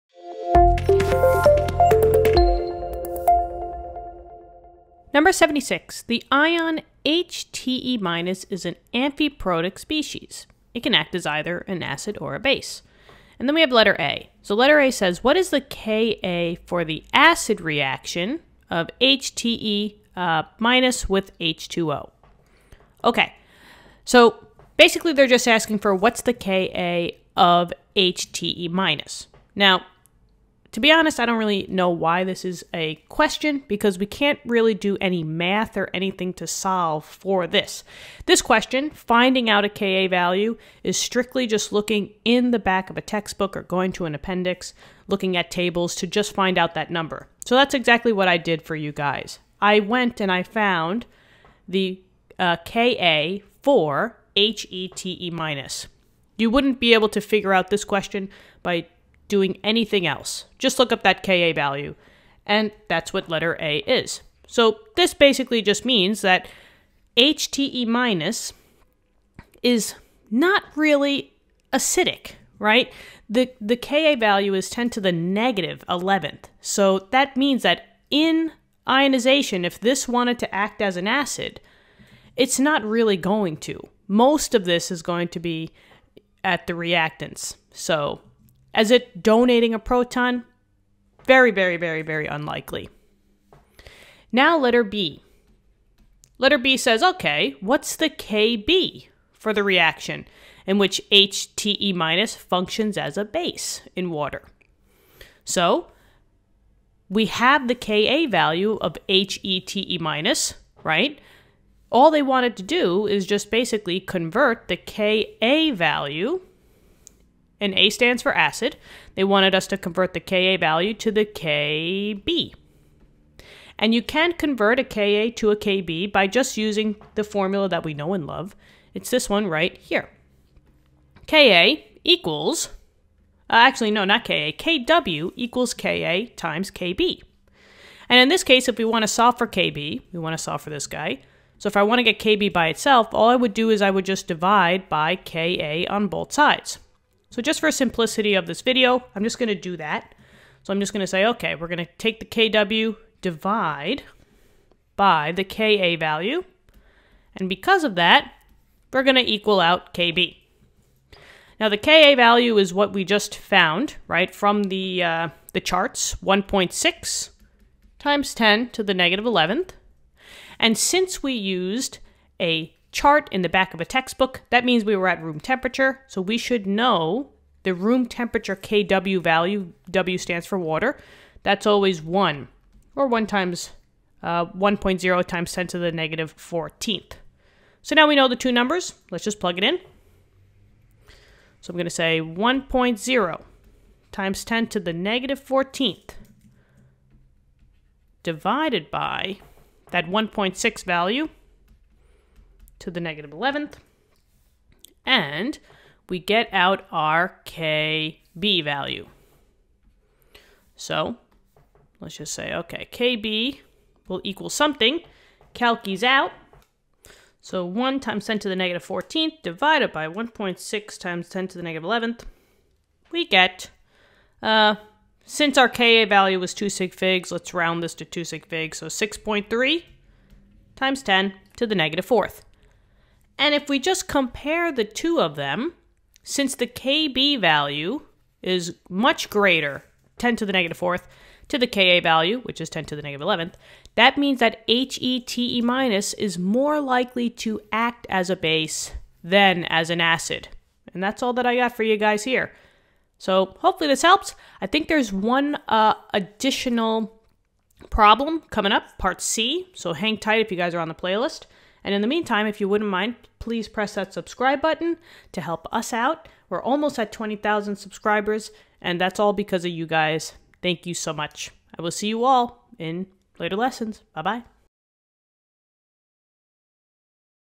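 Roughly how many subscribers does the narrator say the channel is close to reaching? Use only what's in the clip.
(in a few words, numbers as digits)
20,000.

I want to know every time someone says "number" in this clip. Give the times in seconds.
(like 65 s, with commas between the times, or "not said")
5 s, 46 s, 188 s.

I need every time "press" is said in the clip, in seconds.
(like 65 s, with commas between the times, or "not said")
263 s.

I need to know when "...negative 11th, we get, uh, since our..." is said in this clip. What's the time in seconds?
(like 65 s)
221 s.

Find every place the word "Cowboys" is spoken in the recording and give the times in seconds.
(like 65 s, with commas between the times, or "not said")
not said.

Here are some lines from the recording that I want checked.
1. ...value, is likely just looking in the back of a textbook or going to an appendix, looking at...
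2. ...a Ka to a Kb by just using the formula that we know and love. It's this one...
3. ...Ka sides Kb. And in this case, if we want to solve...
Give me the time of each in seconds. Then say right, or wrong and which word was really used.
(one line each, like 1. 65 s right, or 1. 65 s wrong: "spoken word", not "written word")
1. 40 s wrong: "strictly", not "likely"
2. 124 s right
3. 135 s wrong: "times", not "sides".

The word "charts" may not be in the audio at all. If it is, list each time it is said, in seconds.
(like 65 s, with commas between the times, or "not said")
165 s, 172 s.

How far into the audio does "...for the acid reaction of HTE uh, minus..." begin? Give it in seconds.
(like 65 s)
16 s.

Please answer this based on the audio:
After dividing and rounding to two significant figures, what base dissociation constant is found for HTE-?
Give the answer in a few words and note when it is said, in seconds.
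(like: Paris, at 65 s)
6.3 x 10^-4, at 228 s.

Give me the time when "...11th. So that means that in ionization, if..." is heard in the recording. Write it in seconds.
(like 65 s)
75 s.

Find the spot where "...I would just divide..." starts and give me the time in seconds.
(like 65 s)
143 s.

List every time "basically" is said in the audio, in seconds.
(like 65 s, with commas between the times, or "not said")
24 s, 65 s, 113 s.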